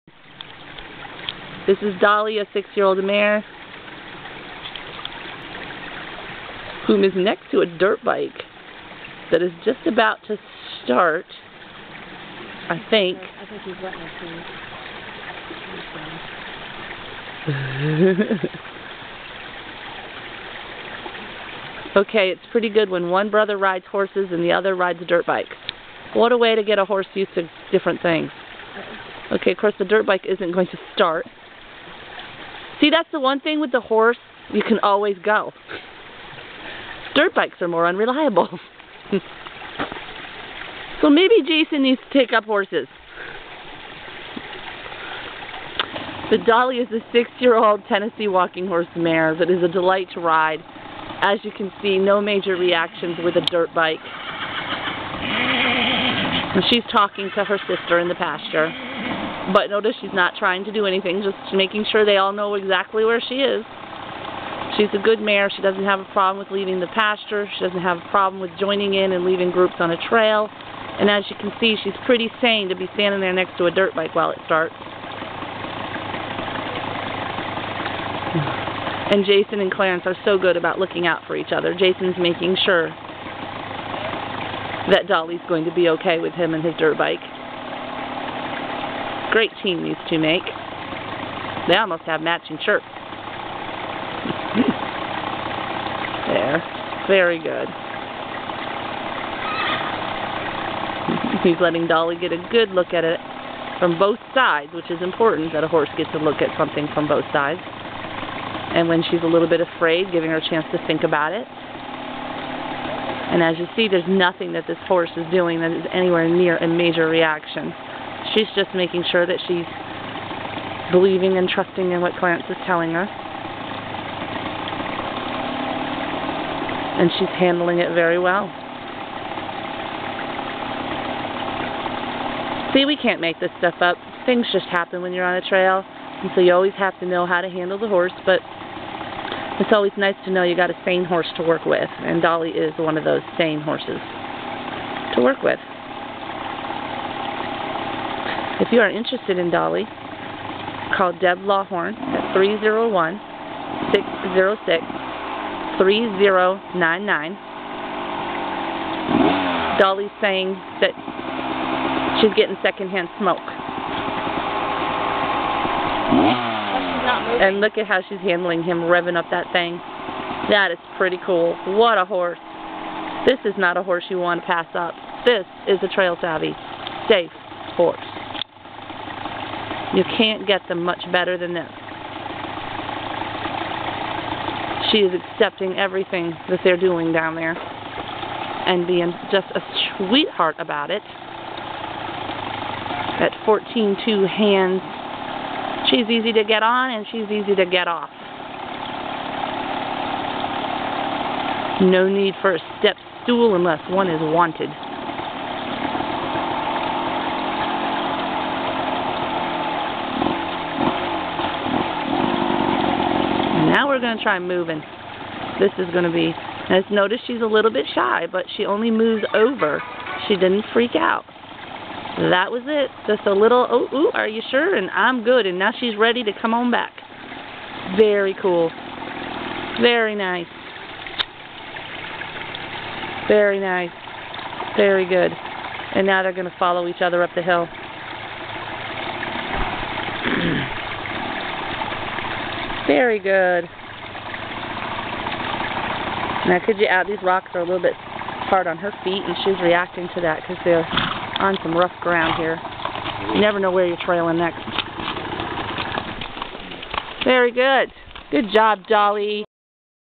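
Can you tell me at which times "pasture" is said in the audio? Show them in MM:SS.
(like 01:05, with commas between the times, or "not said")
00:58, 01:06.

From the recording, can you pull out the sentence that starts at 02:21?
And Dolly is one of those sane horses to work with.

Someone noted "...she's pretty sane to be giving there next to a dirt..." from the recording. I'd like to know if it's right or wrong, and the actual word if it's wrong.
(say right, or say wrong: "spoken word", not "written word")
wrong: "standing", not "giving".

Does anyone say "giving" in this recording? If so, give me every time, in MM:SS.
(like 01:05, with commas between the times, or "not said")
01:50.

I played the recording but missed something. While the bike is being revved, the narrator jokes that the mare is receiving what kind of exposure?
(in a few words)
secondhand smoke.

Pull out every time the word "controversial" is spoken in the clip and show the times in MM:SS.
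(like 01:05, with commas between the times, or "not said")
not said.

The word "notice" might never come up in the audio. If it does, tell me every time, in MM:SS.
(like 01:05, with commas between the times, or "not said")
00:59, 03:36.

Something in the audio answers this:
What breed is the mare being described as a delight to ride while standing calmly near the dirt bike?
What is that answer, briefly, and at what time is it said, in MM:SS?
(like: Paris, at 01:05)
Tennessee walking horse, at 00:47.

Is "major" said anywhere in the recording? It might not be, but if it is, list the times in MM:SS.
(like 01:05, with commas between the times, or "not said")
00:52, 01:56.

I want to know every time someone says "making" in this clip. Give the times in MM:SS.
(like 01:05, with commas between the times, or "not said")
01:01, 01:22, 01:58.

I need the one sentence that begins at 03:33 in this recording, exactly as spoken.
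Now we're going to try moving.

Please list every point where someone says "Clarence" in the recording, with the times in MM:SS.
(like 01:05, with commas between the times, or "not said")
01:19, 02:02.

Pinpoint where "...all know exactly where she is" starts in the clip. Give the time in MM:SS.
01:02.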